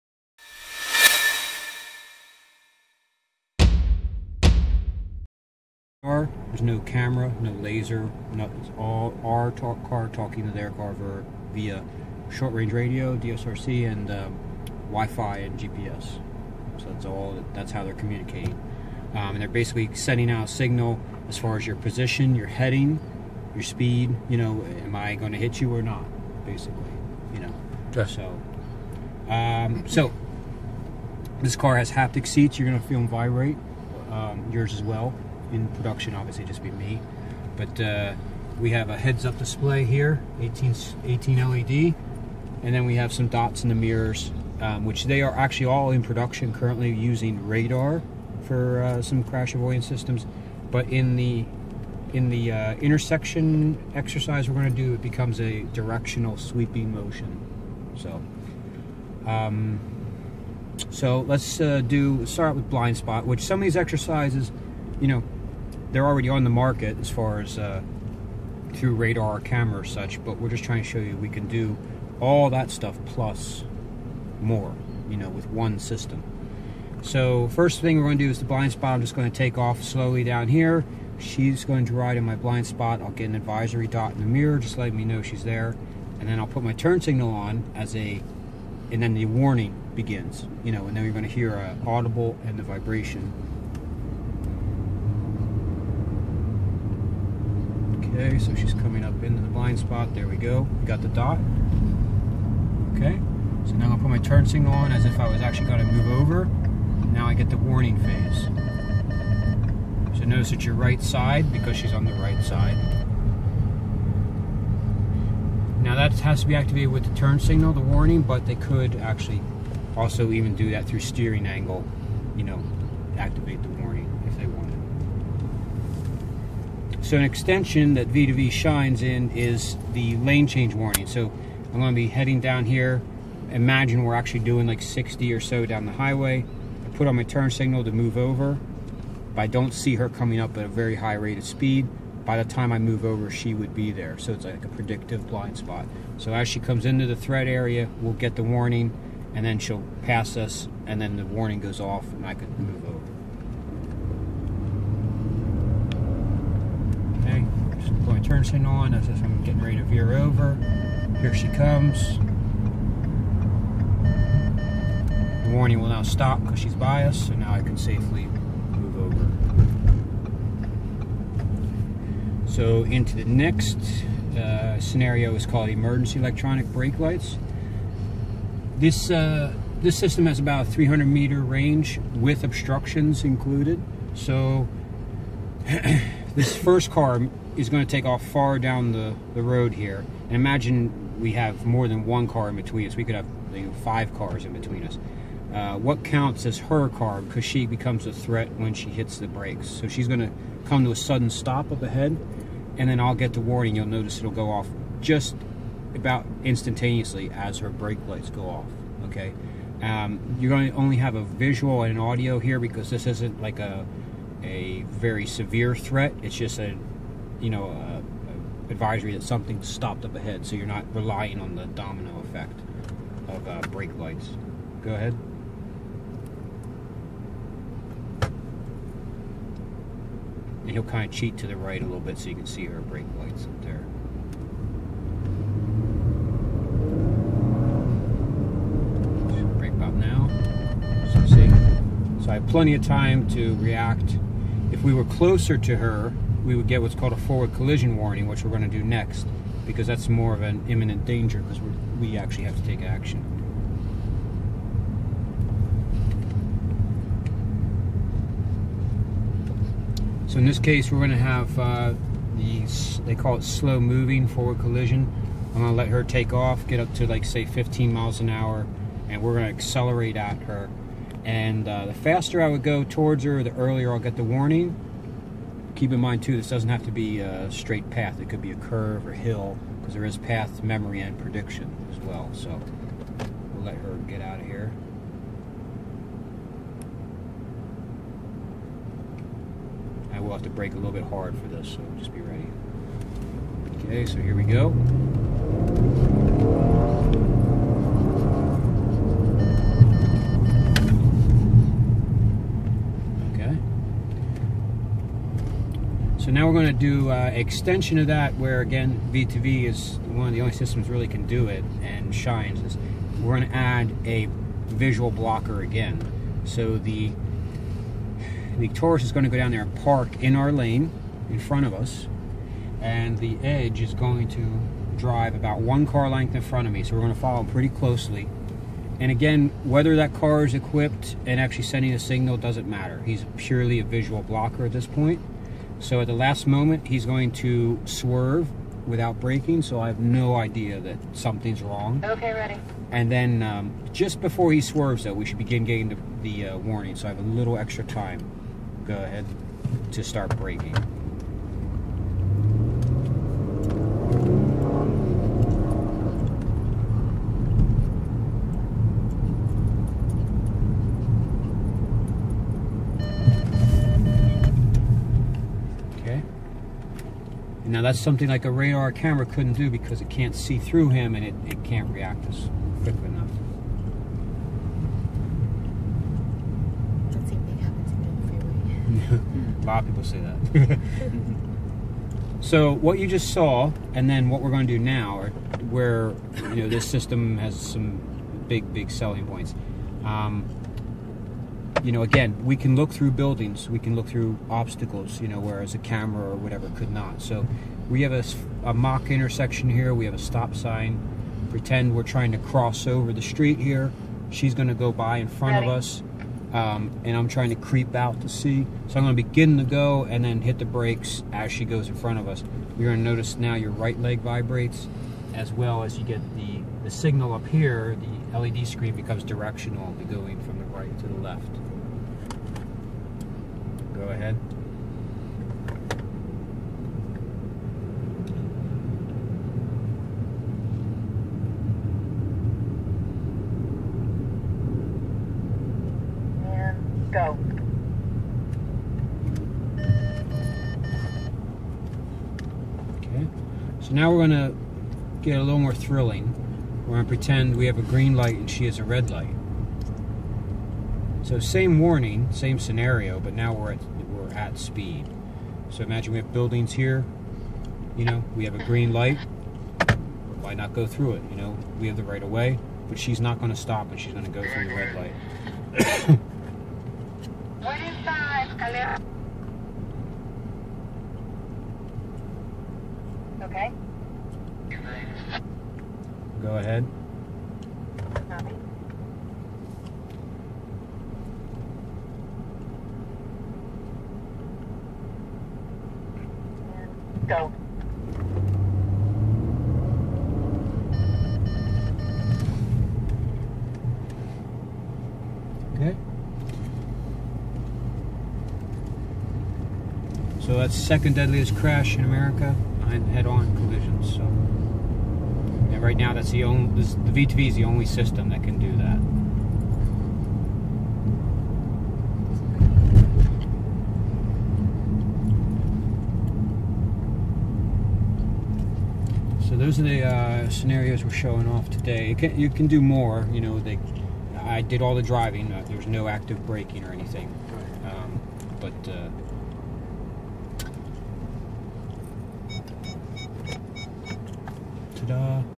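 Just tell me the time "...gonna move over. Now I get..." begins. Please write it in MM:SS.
01:45.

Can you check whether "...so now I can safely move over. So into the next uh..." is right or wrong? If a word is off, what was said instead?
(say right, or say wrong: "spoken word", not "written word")
right.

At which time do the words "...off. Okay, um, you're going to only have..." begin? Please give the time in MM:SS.
03:28.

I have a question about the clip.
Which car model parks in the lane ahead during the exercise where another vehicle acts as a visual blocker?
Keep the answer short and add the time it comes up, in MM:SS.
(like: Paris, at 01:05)
Taurus, at 05:18.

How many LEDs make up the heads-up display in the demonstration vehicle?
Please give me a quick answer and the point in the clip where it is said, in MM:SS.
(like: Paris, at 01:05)
18, at 00:41.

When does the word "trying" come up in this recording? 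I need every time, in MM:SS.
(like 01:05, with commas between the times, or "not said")
01:10, 06:42, 06:47.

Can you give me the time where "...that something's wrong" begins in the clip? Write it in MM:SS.
05:40.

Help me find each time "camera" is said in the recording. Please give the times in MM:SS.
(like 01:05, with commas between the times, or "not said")
00:06, 01:09, 06:08, 06:35.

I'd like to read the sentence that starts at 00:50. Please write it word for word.
But in the in the uh, intersection exercise we're going to do, it becomes a directional sweeping motion.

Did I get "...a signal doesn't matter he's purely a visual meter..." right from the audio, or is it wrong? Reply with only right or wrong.
wrong.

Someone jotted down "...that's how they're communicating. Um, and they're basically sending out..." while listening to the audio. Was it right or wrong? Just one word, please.
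right.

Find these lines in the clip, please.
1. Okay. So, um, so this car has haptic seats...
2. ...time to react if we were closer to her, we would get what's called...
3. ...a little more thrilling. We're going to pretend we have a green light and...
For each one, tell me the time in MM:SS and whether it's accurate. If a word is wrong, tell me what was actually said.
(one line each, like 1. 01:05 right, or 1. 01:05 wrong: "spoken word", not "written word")
1. 00:27 right
2. 04:02 right
3. 07:25 right.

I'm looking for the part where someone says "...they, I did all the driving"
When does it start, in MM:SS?
08:43.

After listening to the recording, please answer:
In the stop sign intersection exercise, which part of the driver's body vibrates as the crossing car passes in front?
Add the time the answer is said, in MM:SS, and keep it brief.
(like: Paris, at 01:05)
right leg, at 06:53.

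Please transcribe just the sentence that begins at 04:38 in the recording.
It could be a curve or hill, because there is path memory and prediction as well.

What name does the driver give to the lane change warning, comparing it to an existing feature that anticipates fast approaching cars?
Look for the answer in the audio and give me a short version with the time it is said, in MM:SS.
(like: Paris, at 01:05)
predictive blind spot, at 02:24.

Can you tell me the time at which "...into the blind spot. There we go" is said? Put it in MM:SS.
01:39.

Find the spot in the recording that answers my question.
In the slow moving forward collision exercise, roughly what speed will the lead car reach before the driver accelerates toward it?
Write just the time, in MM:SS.
04:27.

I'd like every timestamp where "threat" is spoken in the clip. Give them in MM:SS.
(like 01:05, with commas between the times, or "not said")
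02:27, 03:18, 03:35.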